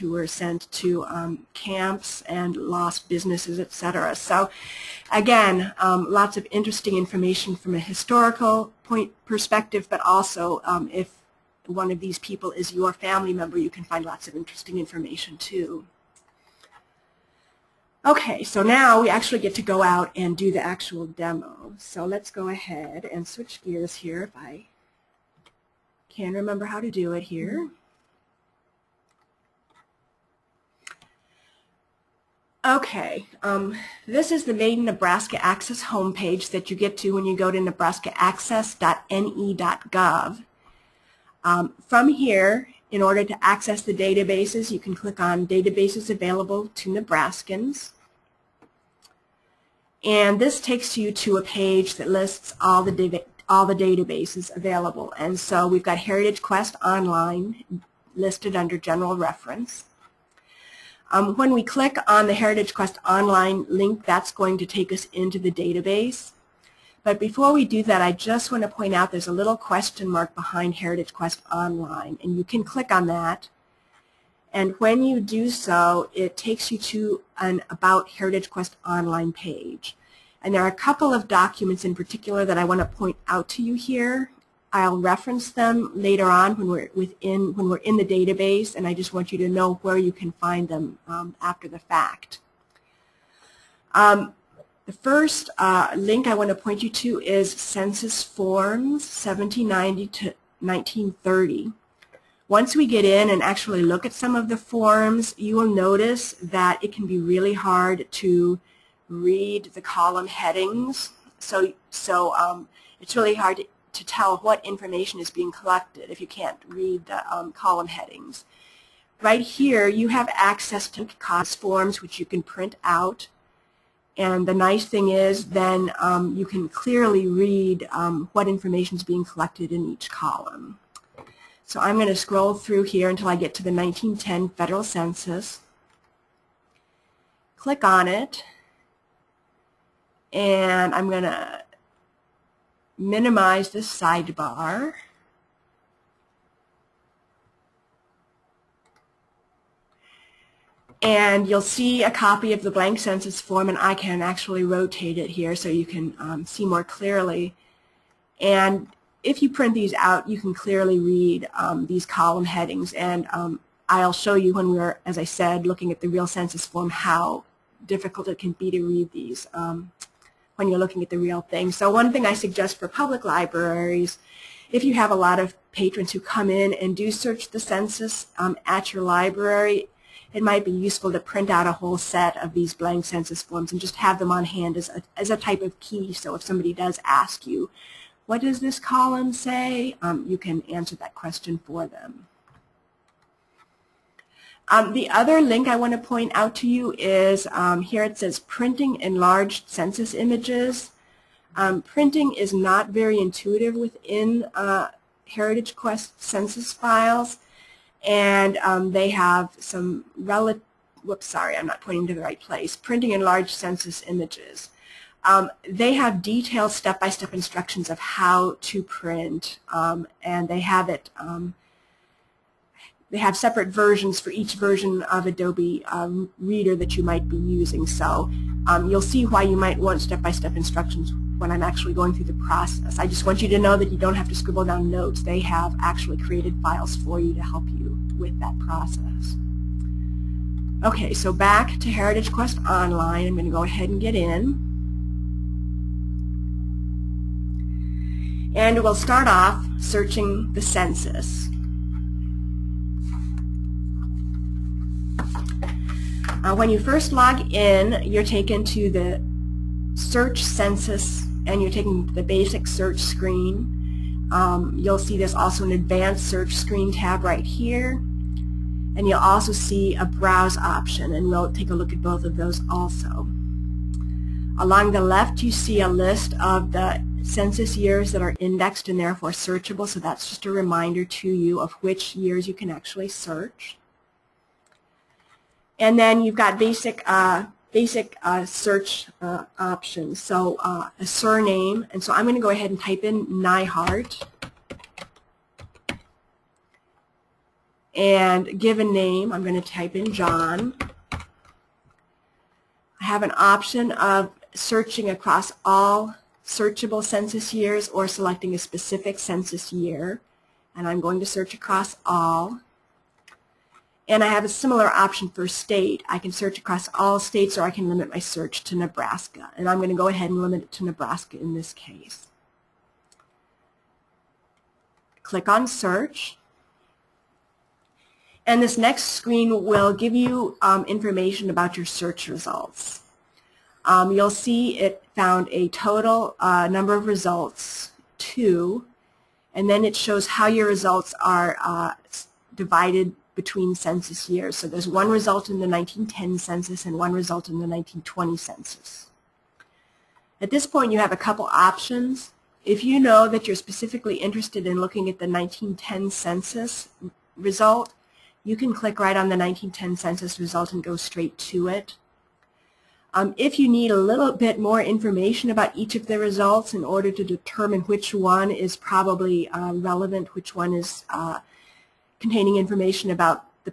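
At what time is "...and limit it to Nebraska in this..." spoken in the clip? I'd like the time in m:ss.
5:20.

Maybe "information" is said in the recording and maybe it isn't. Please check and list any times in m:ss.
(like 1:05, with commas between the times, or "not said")
0:06, 0:14, 1:54, 2:08, 5:30, 6:04, 6:12.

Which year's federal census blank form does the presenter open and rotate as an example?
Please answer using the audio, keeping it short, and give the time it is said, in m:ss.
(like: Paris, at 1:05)
1910, at 2:13.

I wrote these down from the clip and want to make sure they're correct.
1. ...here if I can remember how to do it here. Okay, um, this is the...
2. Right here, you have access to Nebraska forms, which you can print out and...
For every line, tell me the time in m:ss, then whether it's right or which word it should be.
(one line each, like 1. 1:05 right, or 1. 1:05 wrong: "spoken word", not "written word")
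1. 0:23 right
2. 1:59 wrong: "COS", not "Nebraska".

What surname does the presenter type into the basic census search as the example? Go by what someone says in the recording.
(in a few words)
Nyhart.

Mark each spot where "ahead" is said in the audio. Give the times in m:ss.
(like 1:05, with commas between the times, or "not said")
0:22, 4:03, 4:52, 5:20.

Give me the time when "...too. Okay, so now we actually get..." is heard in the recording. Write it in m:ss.
0:15.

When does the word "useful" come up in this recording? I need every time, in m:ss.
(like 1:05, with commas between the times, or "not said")
3:00.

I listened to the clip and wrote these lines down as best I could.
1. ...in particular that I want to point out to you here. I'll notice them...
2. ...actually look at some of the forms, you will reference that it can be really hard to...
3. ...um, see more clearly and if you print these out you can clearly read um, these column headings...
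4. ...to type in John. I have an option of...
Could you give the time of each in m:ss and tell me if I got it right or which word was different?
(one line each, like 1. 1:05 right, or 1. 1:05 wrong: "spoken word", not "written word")
1. 1:21 wrong: "reference", not "notice"
2. 1:43 wrong: "notice", not "reference"
3. 2:36 right
4. 4:59 right.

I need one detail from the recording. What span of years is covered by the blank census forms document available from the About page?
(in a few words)
1790 to 1930.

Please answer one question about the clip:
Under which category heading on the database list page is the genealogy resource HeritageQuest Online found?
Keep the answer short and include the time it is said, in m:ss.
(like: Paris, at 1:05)
General Reference, at 0:58.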